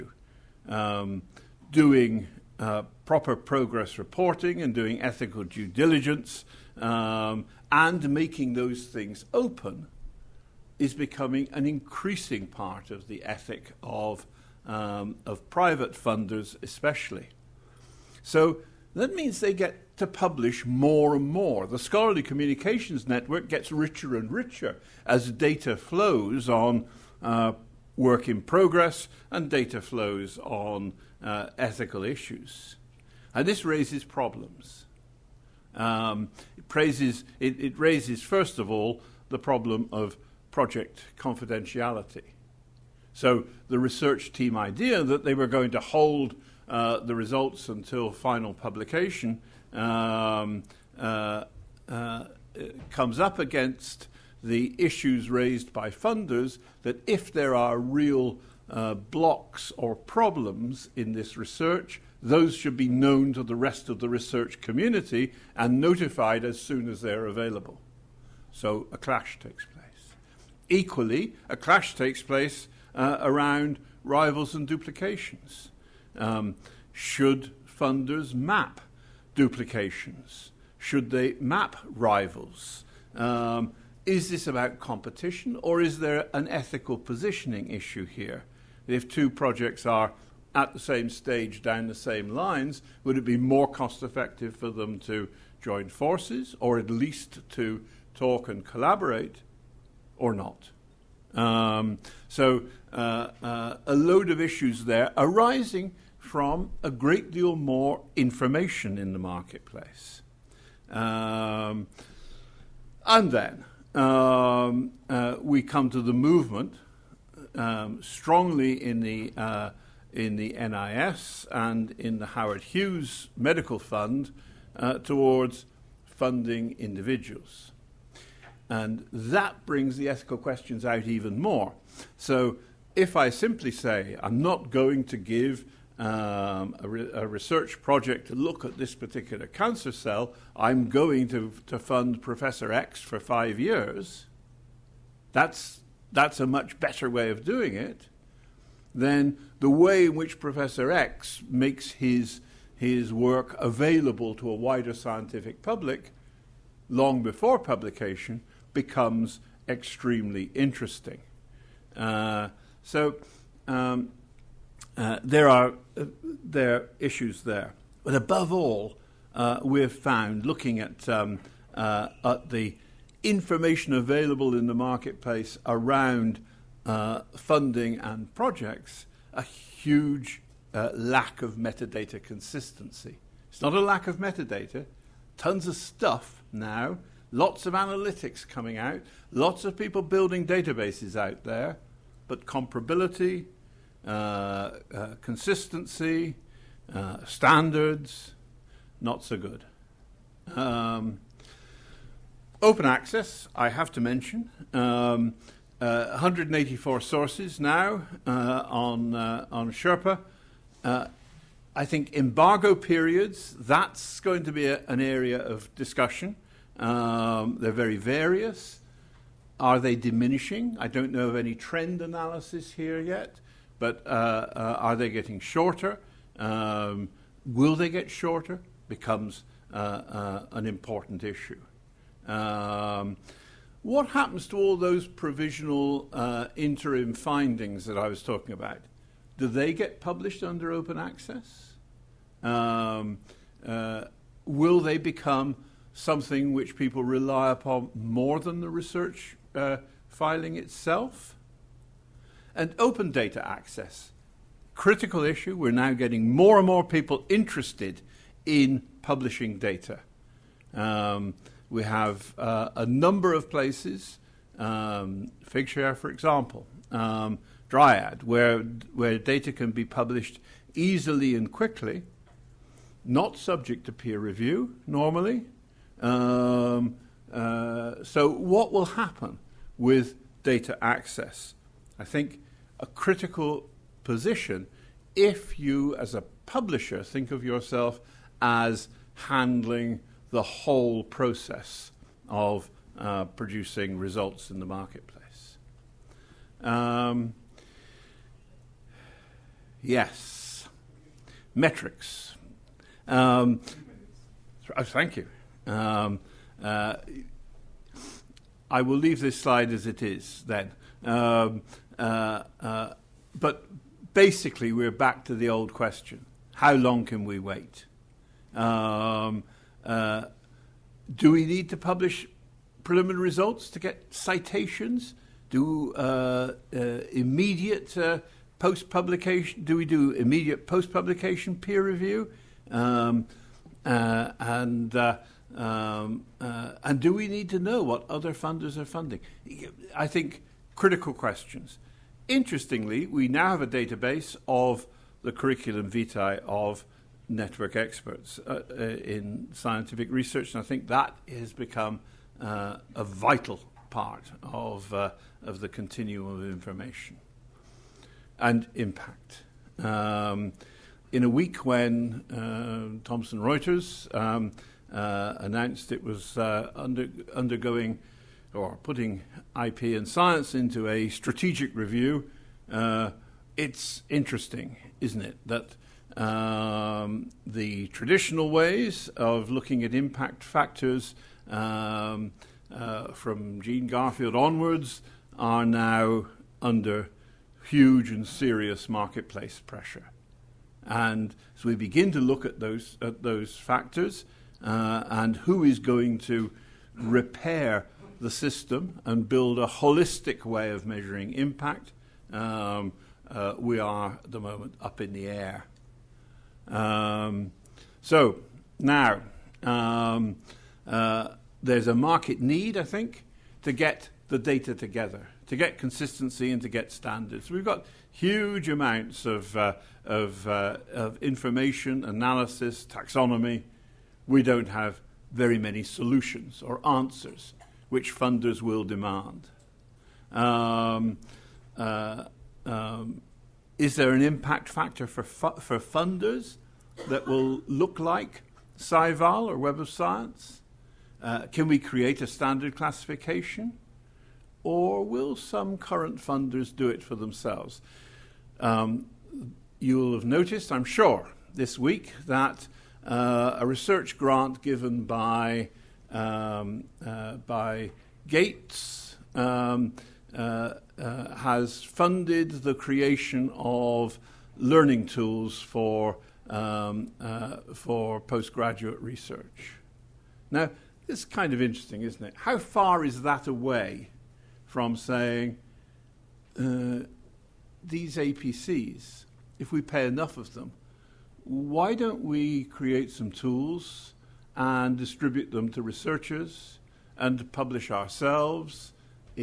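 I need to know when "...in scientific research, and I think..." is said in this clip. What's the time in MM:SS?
05:48.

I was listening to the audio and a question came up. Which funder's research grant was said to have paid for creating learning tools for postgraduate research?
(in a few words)
Gates.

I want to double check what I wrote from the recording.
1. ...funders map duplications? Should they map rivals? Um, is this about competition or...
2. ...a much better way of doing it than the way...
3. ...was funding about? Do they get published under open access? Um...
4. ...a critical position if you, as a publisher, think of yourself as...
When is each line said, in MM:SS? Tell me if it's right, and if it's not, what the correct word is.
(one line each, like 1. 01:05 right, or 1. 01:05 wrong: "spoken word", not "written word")
1. 01:17 right
2. 02:26 right
3. 03:58 wrong: "talking", not "funding"
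4. 04:42 right.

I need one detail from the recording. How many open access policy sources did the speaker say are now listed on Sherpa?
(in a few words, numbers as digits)
184.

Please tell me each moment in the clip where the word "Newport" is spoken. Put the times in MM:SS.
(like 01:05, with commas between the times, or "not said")
not said.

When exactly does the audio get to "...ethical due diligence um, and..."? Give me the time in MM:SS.
00:05.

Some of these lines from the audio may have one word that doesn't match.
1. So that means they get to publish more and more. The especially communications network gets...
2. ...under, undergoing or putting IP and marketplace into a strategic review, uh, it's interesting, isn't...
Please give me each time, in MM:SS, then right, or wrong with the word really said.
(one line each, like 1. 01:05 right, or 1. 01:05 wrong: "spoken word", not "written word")
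1. 00:18 wrong: "scholarly", not "especially"
2. 06:06 wrong: "science", not "marketplace".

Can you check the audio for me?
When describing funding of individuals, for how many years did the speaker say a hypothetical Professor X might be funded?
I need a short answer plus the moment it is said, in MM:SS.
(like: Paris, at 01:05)
5, at 02:23.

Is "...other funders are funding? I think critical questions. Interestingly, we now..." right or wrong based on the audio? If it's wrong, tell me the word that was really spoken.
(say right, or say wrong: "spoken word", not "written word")
right.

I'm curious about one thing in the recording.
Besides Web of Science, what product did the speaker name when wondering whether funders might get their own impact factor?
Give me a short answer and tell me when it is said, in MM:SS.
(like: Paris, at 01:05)
SciVal, at 07:18.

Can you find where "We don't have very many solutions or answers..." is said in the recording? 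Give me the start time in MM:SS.
07:04.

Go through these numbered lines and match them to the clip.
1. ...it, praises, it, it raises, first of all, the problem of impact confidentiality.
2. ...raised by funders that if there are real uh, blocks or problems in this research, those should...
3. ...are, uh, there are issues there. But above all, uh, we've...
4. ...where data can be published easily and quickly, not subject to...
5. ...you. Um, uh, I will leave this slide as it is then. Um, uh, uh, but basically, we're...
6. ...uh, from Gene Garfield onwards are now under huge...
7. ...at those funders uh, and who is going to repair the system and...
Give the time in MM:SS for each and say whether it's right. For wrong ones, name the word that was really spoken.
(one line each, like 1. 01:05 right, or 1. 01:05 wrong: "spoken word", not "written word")
1. 00:36 wrong: "project", not "impact"
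2. 00:55 right
3. 02:45 right
4. 04:28 right
5. 05:05 right
6. 06:22 right
7. 06:33 wrong: "factors", not "funders".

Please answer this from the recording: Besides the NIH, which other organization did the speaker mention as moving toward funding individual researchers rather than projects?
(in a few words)
Howard Hughes Medical Fund.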